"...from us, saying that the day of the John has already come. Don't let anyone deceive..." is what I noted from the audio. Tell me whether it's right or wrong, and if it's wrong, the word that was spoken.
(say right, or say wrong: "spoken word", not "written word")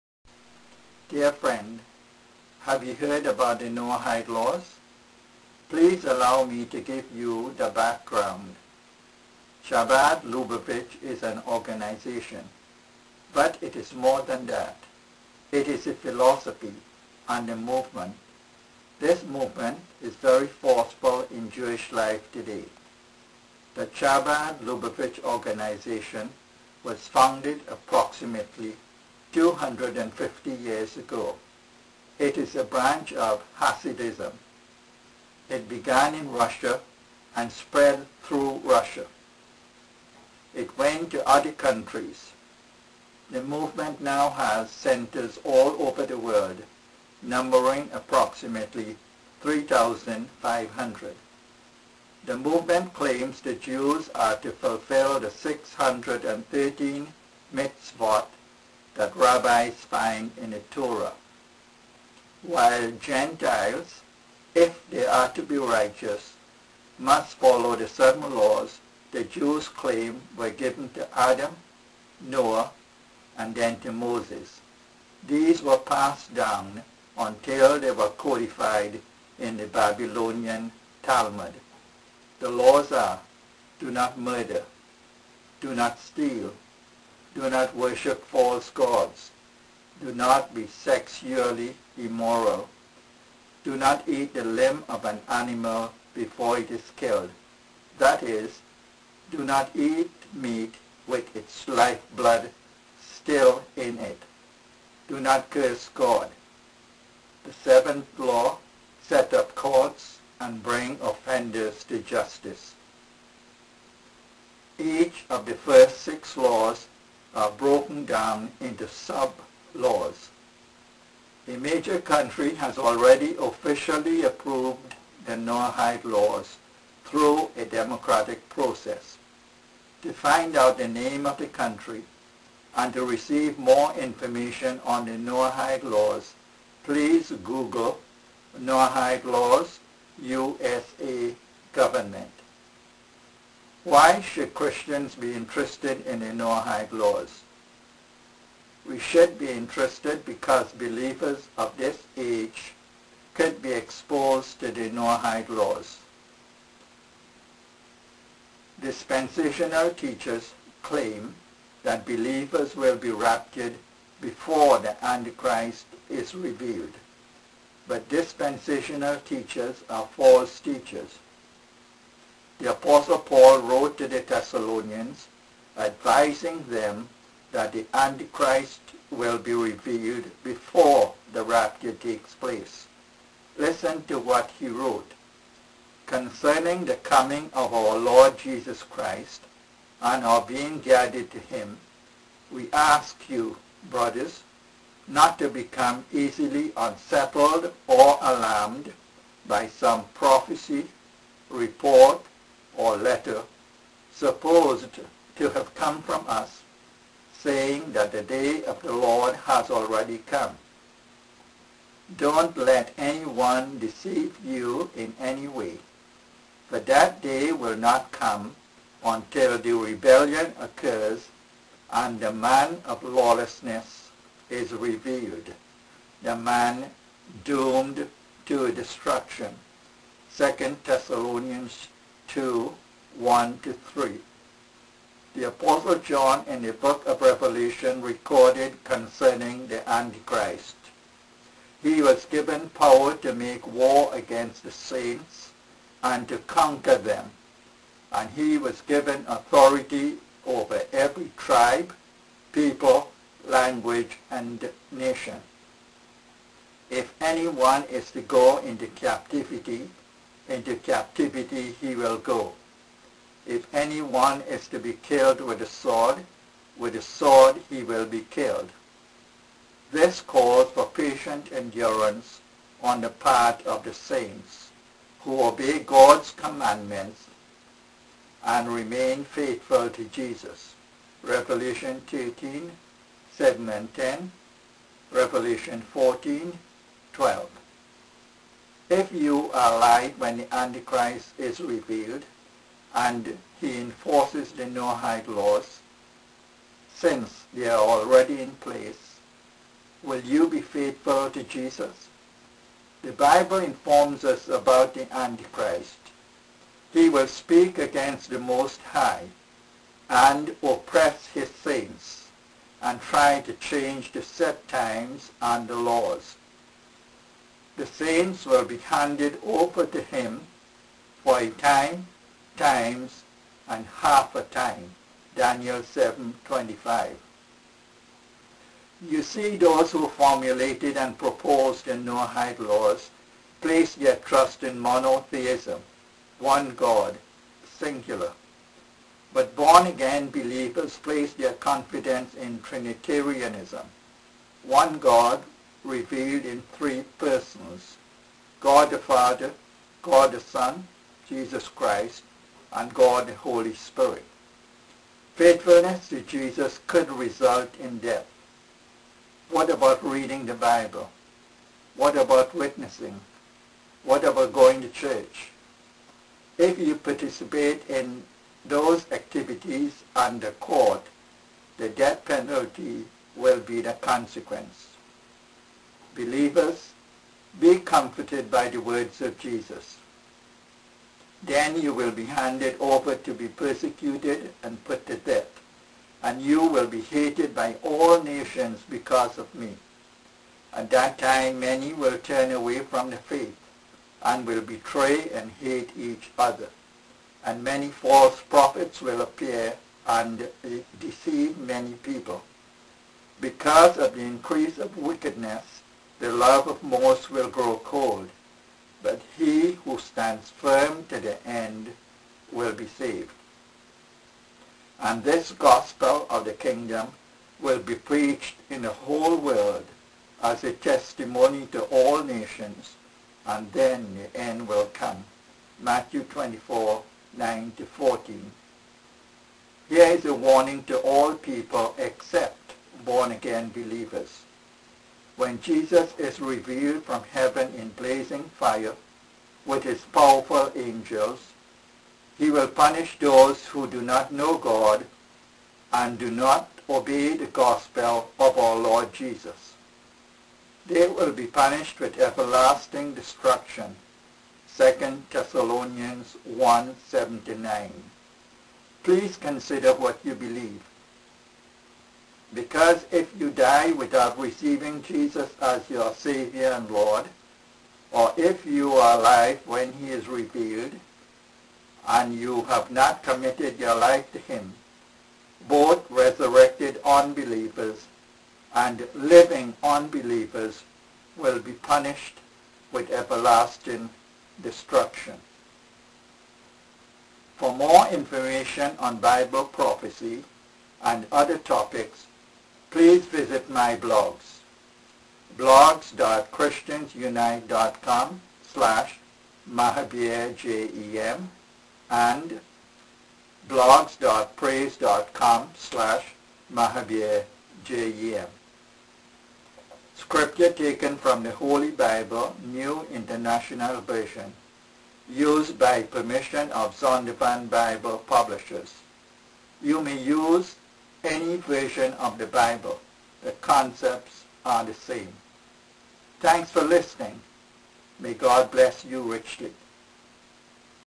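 wrong: "Lord", not "John".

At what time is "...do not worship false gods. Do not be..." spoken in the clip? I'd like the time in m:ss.
1:27.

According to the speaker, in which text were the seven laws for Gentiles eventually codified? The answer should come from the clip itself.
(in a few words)
Babylonian Talmud.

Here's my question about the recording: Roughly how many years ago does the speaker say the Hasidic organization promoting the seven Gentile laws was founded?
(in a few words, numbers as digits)
250 years.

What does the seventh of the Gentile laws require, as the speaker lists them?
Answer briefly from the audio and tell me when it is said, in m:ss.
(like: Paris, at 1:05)
set up courts, at 1:49.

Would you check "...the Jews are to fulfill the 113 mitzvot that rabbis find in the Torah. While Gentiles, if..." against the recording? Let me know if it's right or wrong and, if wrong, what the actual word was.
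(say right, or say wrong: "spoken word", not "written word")
wrong: "613", not "113".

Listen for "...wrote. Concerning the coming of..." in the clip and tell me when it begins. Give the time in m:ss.
3:04.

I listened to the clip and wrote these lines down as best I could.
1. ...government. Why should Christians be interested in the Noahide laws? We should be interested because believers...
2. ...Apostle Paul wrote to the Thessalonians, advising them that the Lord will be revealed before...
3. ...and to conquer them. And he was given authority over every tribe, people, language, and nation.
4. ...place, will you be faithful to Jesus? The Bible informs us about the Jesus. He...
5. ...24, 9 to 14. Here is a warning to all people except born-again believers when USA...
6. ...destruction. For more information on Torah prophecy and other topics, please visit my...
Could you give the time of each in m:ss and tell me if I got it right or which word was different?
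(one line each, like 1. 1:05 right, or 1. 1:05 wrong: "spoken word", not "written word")
1. 2:21 right
2. 2:52 wrong: "Antichrist", not "Lord"
3. 4:06 right
4. 4:58 wrong: "Antichrist", not "Jesus"
5. 7:06 wrong: "Jesus", not "USA"
6. 8:04 wrong: "Bible", not "Torah".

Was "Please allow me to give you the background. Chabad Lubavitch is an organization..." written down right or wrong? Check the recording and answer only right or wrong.
right.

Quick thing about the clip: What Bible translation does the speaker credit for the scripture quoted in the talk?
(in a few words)
New International Version.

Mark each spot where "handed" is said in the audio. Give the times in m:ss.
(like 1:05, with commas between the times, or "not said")
5:18, 6:22.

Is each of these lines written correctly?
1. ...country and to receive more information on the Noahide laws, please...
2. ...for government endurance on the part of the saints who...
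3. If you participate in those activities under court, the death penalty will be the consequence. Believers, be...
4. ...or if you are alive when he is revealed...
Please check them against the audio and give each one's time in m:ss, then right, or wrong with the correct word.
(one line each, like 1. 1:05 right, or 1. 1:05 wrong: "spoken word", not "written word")
1. 2:11 right
2. 4:30 wrong: "patient", not "government"
3. 6:06 right
4. 7:48 right.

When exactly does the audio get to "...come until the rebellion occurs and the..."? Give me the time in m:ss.
3:38.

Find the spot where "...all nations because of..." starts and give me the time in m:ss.
6:27.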